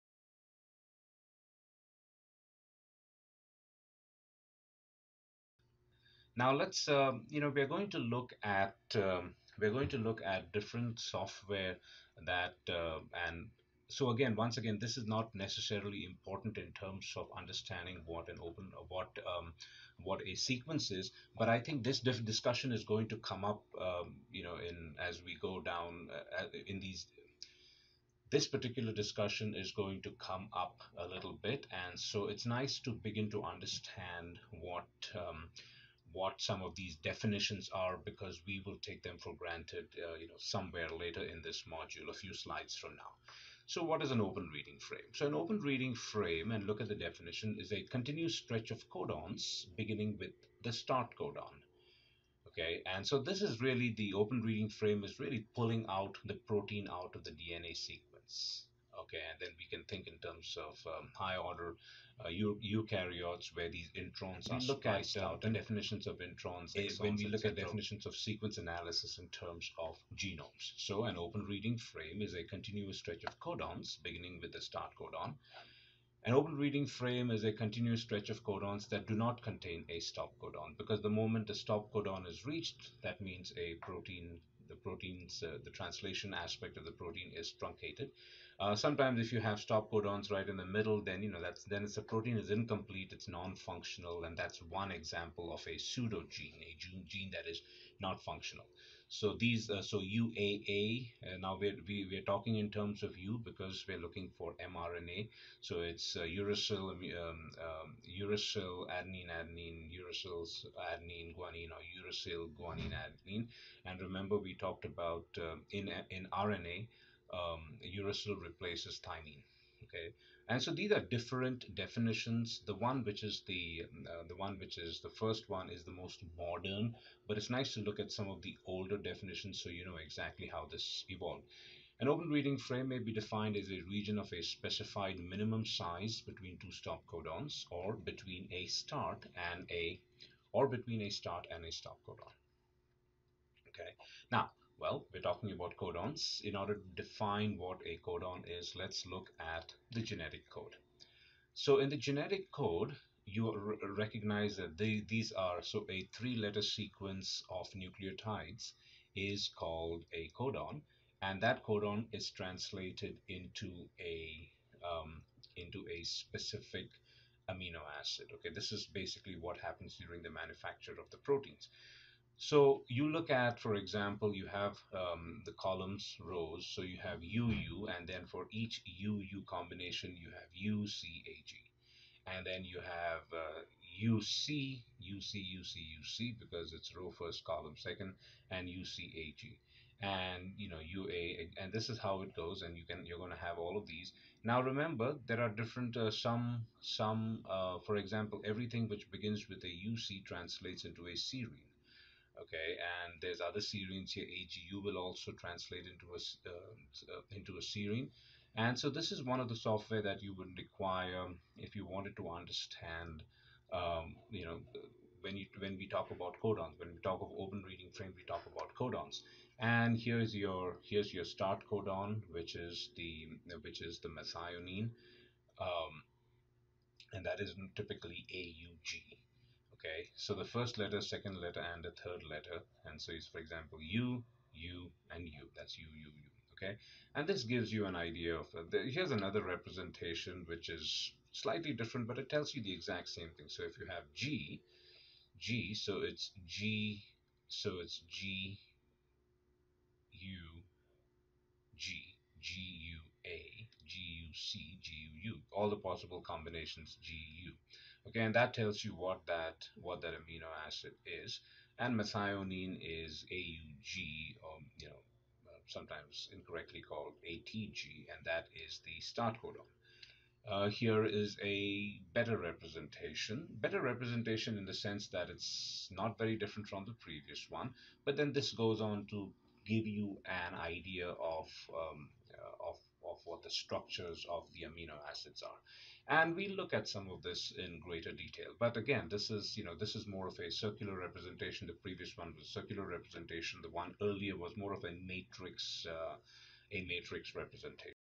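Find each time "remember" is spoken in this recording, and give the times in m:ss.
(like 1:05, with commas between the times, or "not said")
1:53, 3:14.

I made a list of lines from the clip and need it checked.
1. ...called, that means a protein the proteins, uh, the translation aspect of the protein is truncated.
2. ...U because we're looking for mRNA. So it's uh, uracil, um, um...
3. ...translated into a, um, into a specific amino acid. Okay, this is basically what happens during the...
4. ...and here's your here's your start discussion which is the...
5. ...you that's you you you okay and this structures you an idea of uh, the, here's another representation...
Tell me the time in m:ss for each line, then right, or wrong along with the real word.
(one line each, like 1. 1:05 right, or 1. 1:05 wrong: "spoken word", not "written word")
1. 1:22 wrong: "reached", not "called"
2. 1:43 right
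3. 2:42 right
4. 3:39 wrong: "codon", not "discussion"
5. 3:55 wrong: "gives", not "structures".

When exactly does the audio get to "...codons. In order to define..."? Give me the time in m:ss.
2:25.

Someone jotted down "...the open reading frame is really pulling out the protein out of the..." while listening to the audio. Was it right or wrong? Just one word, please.
right.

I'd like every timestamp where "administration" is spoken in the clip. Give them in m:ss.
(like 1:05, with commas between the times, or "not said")
not said.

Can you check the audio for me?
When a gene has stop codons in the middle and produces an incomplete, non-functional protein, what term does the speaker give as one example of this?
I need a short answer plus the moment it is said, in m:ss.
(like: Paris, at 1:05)
pseudogene, at 1:35.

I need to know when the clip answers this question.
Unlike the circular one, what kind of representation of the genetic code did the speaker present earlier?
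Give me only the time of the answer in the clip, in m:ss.
4:56.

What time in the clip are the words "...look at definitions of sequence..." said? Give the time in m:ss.
1:07.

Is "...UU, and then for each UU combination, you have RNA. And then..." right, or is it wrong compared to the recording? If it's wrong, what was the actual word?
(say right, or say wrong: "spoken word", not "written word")
wrong: "UCAG", not "RNA".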